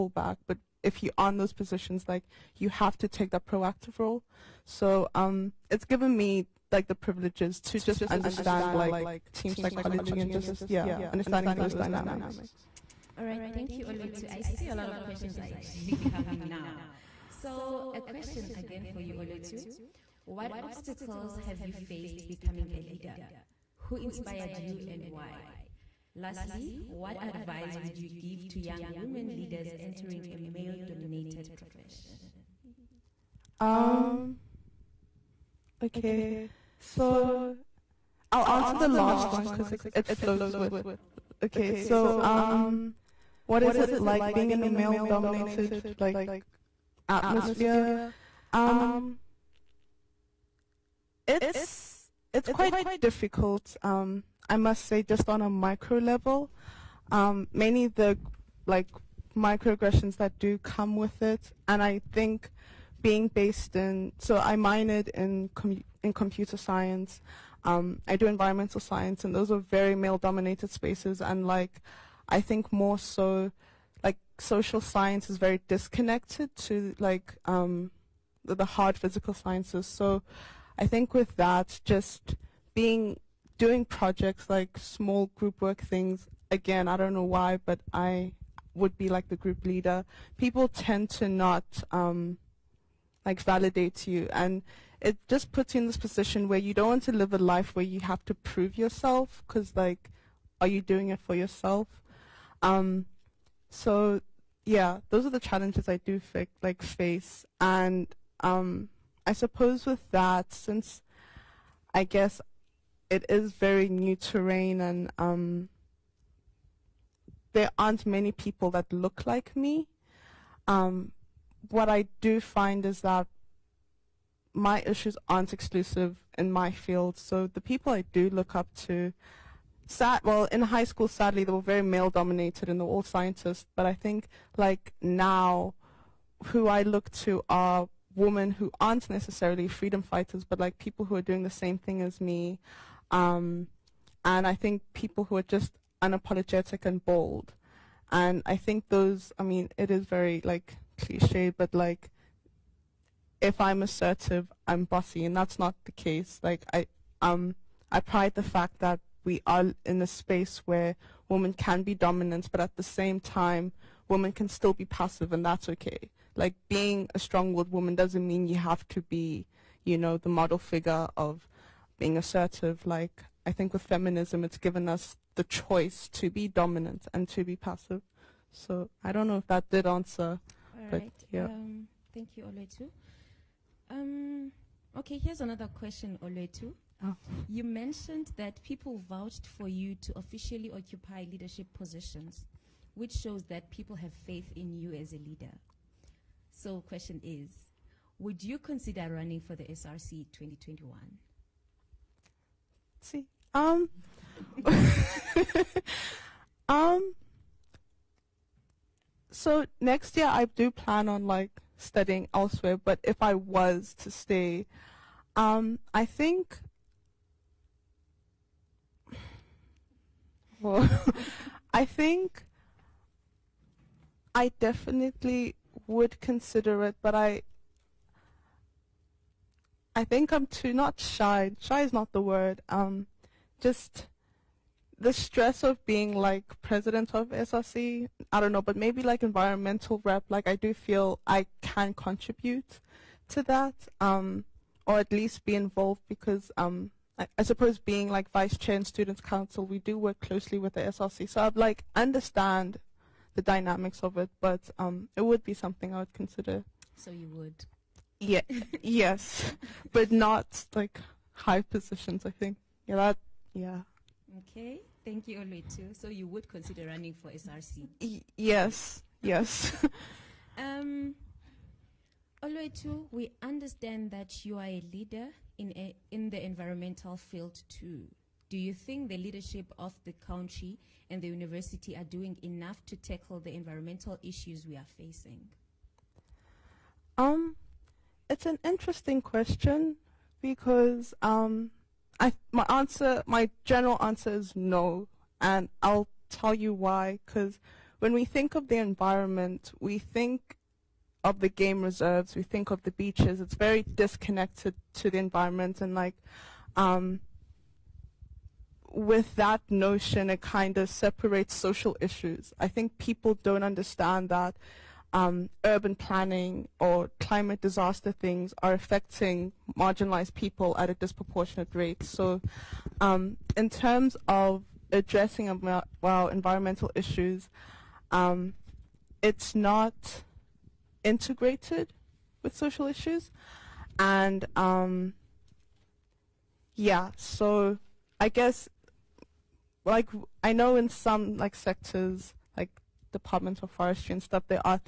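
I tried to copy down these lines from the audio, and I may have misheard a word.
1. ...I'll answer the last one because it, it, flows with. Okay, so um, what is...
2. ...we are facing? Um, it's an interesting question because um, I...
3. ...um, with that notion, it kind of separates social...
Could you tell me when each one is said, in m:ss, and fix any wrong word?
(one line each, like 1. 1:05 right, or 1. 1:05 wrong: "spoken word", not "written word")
1. 0:38 right
2. 4:44 right
3. 5:06 right.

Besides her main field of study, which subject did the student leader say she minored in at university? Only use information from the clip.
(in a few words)
Computer science.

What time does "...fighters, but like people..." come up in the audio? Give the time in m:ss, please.
2:20.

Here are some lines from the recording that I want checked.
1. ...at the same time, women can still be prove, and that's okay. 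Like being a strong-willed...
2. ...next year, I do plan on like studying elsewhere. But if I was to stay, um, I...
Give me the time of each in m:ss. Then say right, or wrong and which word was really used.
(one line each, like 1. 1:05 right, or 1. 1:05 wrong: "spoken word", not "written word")
1. 2:42 wrong: "passive", not "prove"
2. 3:29 right.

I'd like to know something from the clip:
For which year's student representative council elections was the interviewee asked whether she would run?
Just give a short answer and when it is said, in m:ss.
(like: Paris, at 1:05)
2021, at 3:20.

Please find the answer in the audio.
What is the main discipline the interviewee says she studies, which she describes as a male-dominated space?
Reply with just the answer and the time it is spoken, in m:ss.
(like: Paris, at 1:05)
Environmental science, at 1:08.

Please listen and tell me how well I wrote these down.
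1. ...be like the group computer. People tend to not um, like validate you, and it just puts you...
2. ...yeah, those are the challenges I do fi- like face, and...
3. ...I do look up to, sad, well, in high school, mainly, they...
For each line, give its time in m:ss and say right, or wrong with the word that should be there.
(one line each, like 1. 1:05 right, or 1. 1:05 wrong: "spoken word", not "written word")
1. 1:28 wrong: "leader", not "computer"
2. 1:44 right
3. 2:07 wrong: "sadly", not "mainly".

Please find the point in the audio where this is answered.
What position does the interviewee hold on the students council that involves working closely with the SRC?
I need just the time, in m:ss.
4:08.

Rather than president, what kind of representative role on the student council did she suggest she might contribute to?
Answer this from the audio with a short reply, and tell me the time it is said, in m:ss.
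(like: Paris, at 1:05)
Environmental rep, at 3:59.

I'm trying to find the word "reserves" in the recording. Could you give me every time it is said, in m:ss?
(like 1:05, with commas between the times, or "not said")
5:01.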